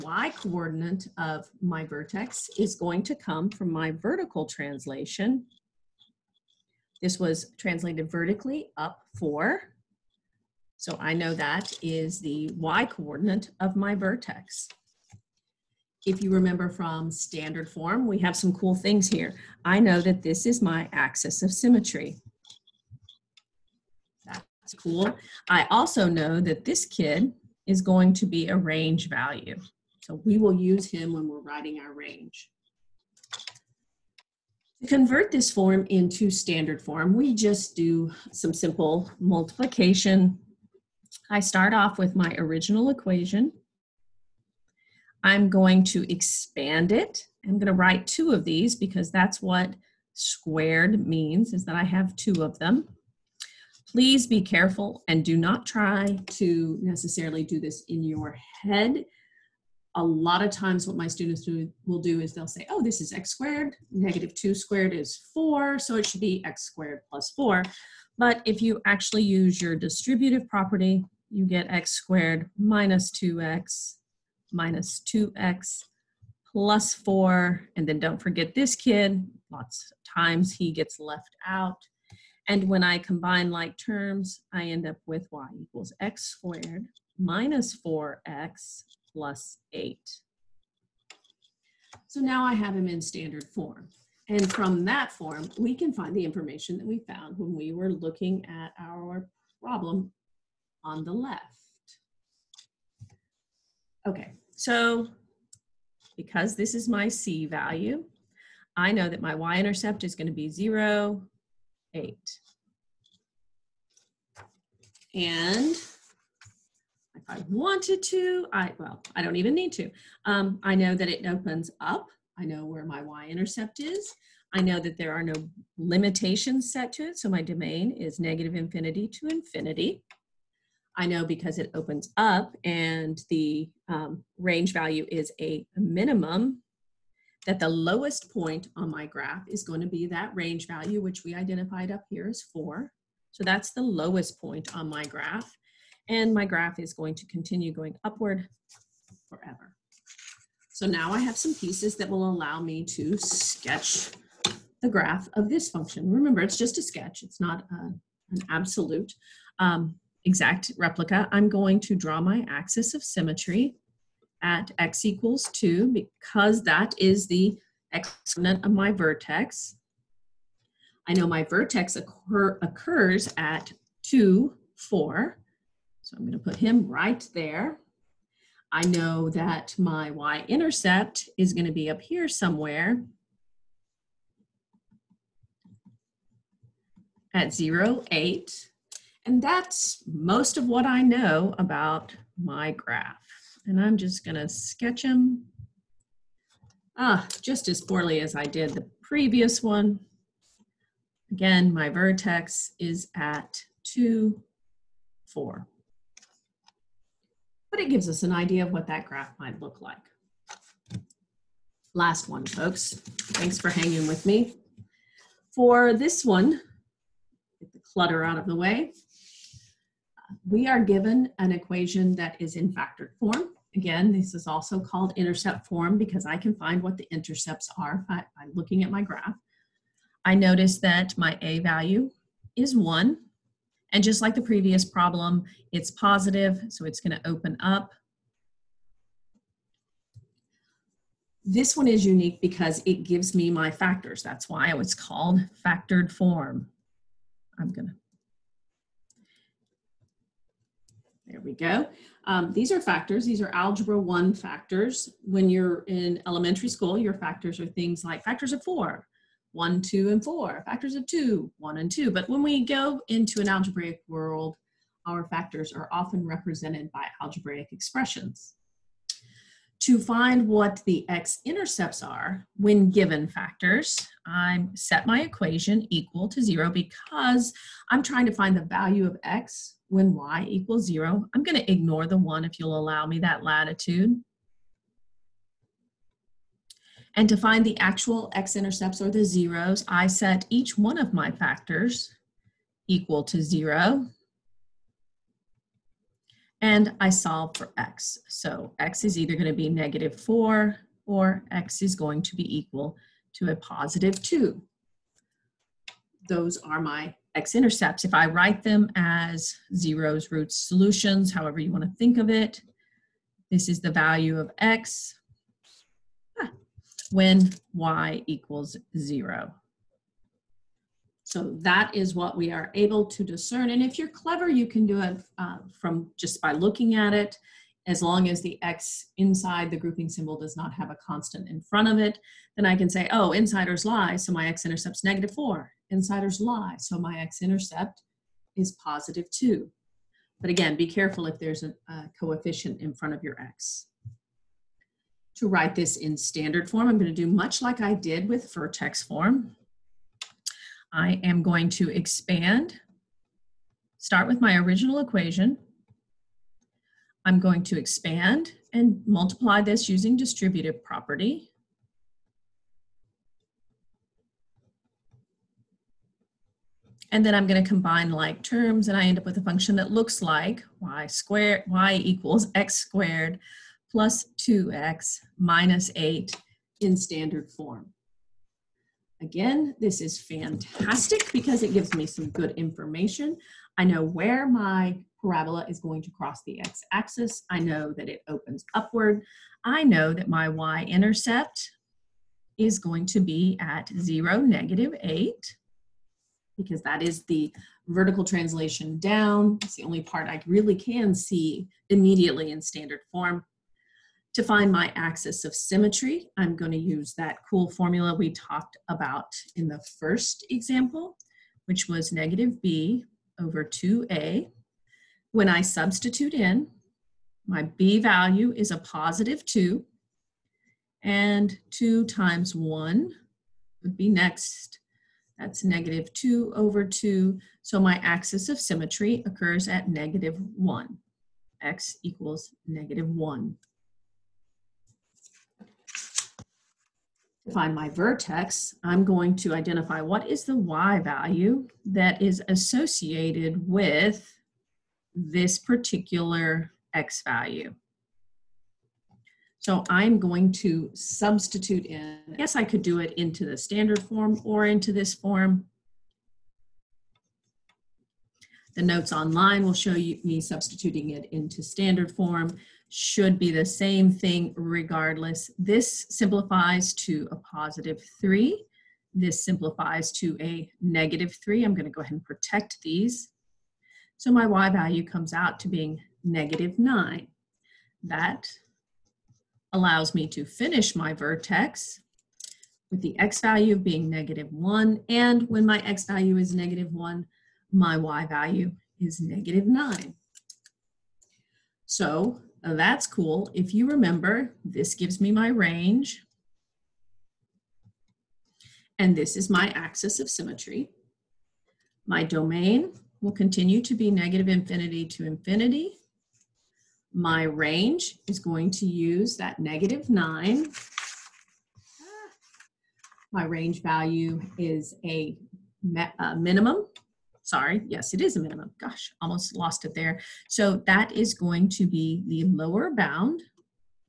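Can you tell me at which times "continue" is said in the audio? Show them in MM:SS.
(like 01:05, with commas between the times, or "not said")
02:27, 08:23.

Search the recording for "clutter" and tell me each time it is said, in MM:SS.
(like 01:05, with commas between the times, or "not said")
03:37.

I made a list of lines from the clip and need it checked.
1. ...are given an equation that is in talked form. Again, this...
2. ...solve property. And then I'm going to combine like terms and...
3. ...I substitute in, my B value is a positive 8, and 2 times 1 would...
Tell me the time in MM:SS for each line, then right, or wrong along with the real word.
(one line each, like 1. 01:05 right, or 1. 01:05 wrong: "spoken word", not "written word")
1. 03:40 wrong: "factored", not "talked"
2. 06:00 wrong: "distributive", not "solve"
3. 06:55 wrong: "2", not "8".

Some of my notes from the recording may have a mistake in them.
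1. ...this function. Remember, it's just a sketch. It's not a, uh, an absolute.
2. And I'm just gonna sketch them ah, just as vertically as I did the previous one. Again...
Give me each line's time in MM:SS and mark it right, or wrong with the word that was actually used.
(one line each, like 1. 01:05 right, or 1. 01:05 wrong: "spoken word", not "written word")
1. 02:35 right
2. 03:13 wrong: "poorly", not "vertically".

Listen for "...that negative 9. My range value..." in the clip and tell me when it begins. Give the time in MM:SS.
08:29.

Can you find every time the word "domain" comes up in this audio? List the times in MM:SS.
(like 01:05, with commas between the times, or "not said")
02:07, 08:22.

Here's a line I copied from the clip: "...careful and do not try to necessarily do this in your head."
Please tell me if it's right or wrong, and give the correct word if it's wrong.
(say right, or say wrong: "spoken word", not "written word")
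right.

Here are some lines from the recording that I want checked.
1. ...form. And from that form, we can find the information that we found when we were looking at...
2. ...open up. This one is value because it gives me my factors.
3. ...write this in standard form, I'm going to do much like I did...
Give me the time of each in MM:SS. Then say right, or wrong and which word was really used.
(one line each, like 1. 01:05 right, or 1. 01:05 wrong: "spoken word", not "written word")
1. 01:33 right
2. 03:57 wrong: "unique", not "value"
3. 05:45 right.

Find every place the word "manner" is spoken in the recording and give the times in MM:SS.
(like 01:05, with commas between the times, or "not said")
not said.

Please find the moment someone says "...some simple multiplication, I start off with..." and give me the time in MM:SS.
00:38.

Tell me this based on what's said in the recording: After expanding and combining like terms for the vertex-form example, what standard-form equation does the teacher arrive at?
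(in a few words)
y = x^2 - 4x + 8.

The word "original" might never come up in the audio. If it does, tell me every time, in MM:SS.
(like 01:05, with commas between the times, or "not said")
00:42, 05:54.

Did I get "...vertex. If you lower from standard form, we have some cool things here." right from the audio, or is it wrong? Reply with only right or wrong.
wrong.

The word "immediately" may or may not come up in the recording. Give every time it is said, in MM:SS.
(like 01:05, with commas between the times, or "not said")
06:41.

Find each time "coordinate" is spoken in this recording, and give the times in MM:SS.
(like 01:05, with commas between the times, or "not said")
00:00, 00:12.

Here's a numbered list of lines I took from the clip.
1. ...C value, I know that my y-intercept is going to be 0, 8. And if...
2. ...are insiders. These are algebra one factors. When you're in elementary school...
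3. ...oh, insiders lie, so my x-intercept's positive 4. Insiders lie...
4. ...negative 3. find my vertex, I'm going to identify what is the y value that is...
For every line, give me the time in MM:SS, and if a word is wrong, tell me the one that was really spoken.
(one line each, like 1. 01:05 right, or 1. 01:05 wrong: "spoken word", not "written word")
1. 01:47 right
2. 04:12 wrong: "factors", not "insiders"
3. 05:33 wrong: "negative", not "positive"
4. 07:12 wrong: "1", not "3".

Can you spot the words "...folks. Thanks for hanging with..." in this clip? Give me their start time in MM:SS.
03:32.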